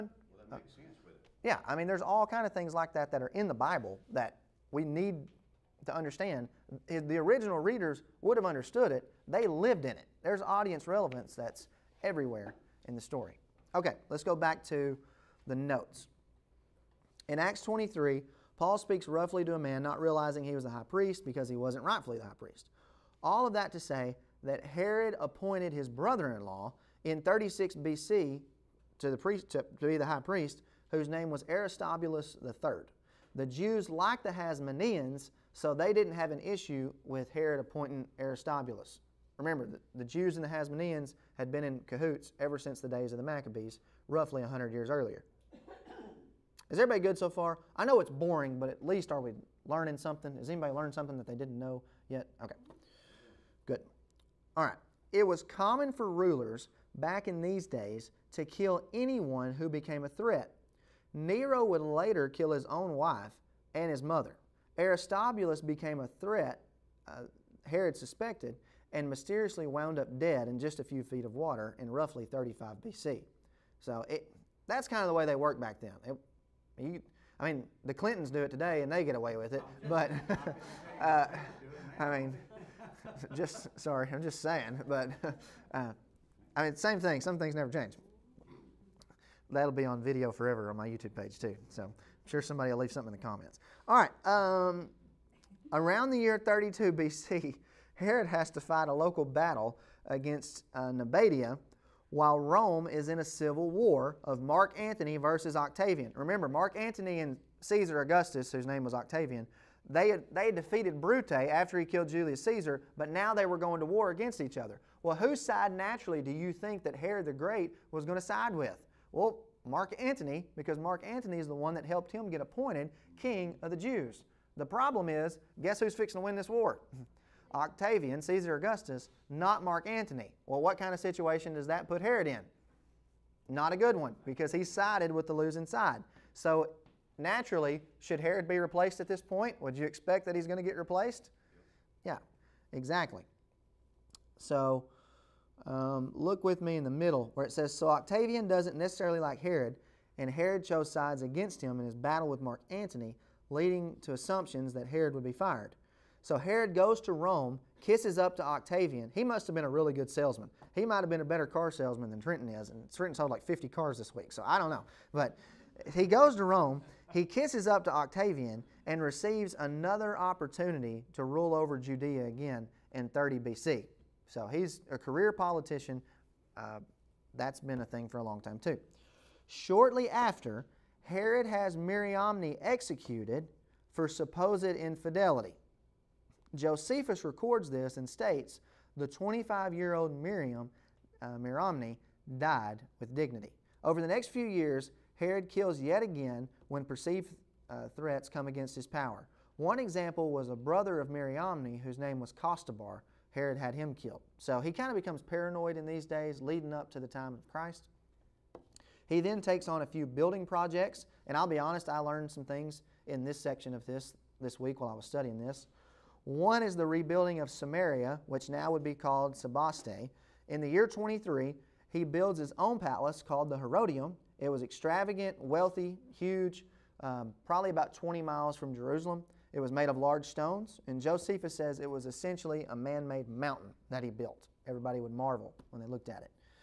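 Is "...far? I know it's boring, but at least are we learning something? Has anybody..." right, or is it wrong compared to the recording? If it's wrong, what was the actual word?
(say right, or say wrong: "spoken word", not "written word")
right.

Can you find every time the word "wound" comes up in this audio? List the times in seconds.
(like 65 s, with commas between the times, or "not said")
69 s.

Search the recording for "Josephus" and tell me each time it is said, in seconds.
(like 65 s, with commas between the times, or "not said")
186 s, 230 s.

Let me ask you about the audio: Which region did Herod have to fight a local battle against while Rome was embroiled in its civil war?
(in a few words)
Nabatea.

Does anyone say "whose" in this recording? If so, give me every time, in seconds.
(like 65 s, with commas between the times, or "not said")
30 s, 108 s, 115 s, 201 s.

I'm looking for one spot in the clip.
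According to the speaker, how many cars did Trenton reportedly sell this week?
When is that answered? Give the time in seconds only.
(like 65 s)
163 s.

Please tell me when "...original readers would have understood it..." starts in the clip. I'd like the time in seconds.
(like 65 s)
7 s.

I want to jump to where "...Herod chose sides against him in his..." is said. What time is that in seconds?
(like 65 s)
150 s.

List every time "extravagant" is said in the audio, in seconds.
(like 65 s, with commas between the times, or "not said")
224 s.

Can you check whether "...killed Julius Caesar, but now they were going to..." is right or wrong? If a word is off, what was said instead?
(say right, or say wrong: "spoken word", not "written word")
right.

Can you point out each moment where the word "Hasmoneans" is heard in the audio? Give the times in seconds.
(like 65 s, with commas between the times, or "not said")
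34 s, 40 s.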